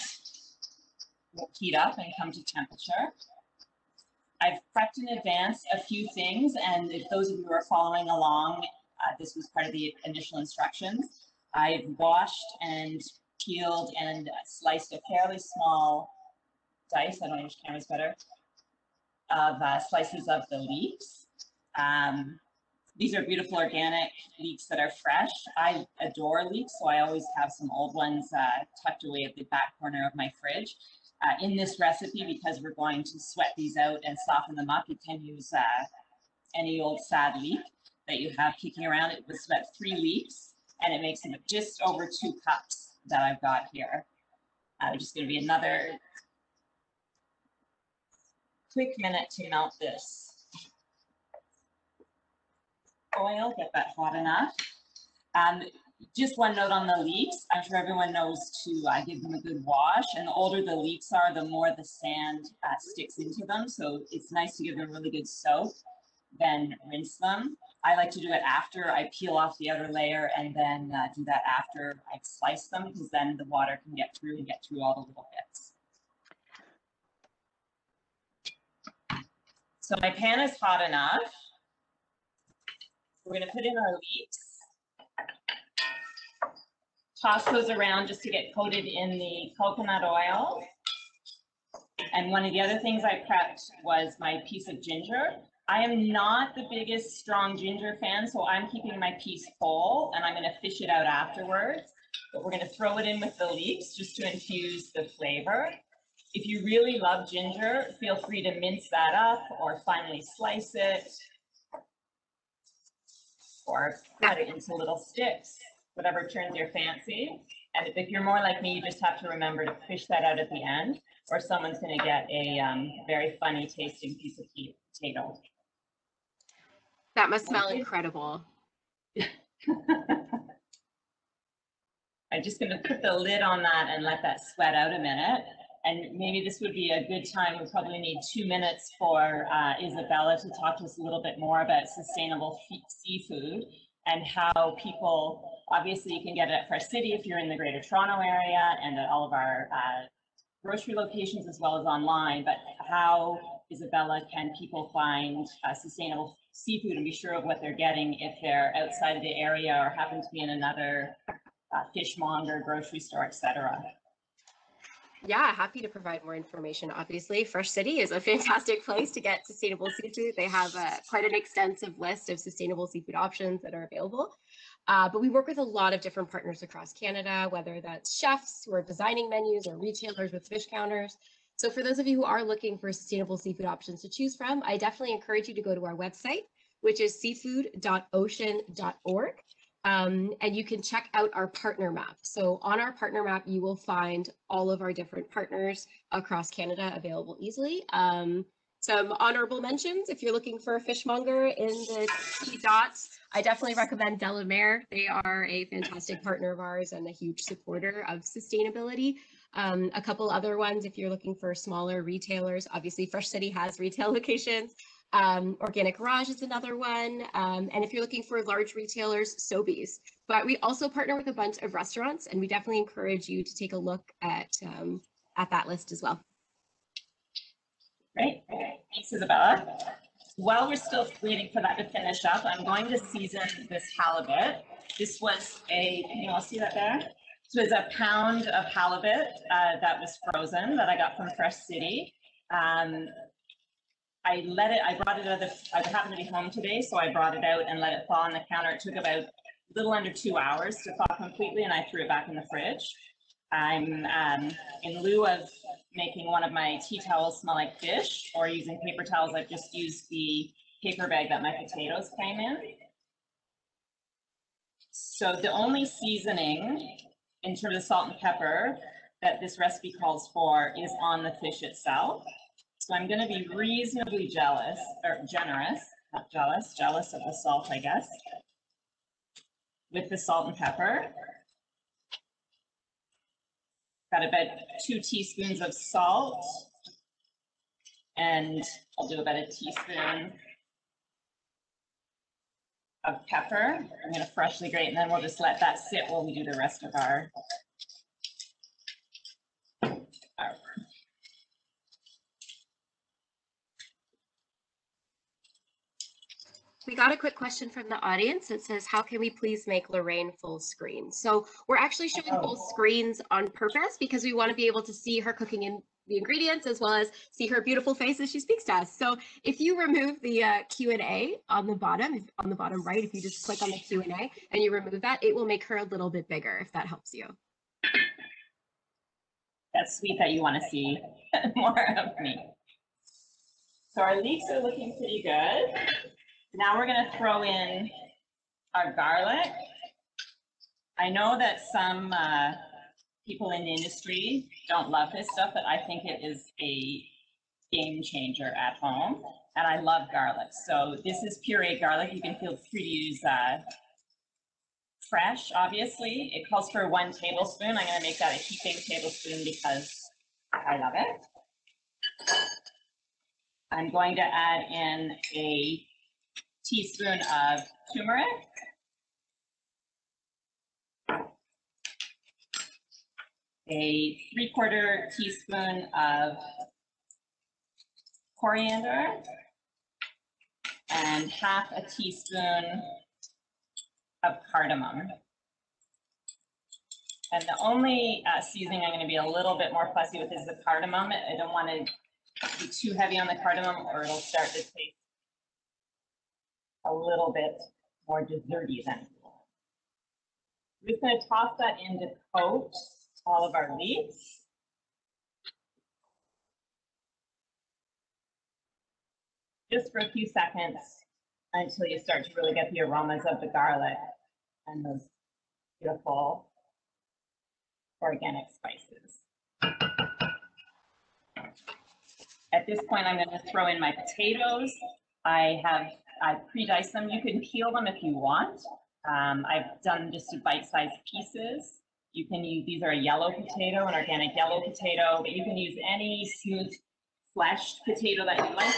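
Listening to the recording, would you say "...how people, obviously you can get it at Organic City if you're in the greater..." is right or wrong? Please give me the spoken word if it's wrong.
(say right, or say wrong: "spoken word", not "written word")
wrong: "Fresh", not "Organic".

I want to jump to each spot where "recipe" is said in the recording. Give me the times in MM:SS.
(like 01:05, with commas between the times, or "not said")
00:31, 04:29.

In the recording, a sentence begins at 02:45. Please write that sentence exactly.
Yeah, happy to provide more information.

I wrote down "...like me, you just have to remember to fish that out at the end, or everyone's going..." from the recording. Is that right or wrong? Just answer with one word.
wrong.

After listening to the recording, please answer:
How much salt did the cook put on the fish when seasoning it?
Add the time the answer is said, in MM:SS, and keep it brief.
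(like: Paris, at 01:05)
2 teaspoons, at 04:44.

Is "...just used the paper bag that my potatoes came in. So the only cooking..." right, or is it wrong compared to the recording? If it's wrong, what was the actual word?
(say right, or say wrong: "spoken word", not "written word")
wrong: "seasoning", not "cooking".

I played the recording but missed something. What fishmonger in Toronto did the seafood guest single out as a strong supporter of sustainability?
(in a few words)
De La Mer.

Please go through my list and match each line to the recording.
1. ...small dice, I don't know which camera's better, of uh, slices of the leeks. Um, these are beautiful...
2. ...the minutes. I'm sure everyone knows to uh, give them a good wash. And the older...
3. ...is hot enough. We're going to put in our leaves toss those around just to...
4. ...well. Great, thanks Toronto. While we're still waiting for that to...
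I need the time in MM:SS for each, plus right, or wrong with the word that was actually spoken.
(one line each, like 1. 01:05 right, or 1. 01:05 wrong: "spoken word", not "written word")
1. 00:15 right
2. 00:56 wrong: "leaves", not "minutes"
3. 01:20 right
4. 03:46 wrong: "Isabella", not "Toronto".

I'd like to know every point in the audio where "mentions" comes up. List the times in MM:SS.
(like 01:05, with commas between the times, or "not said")
03:19.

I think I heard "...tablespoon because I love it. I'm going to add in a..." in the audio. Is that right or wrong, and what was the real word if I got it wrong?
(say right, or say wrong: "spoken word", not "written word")
right.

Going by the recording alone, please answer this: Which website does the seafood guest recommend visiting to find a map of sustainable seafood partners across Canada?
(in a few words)
seafood.ocean.org.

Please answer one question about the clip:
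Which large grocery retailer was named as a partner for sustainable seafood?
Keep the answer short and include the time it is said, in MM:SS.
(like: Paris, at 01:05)
Sobeys, at 03:39.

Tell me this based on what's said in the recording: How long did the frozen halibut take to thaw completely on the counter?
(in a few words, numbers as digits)
Under 2 hours.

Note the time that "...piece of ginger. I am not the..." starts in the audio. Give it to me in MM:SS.
01:34.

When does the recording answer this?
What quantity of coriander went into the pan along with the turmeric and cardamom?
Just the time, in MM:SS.
06:14.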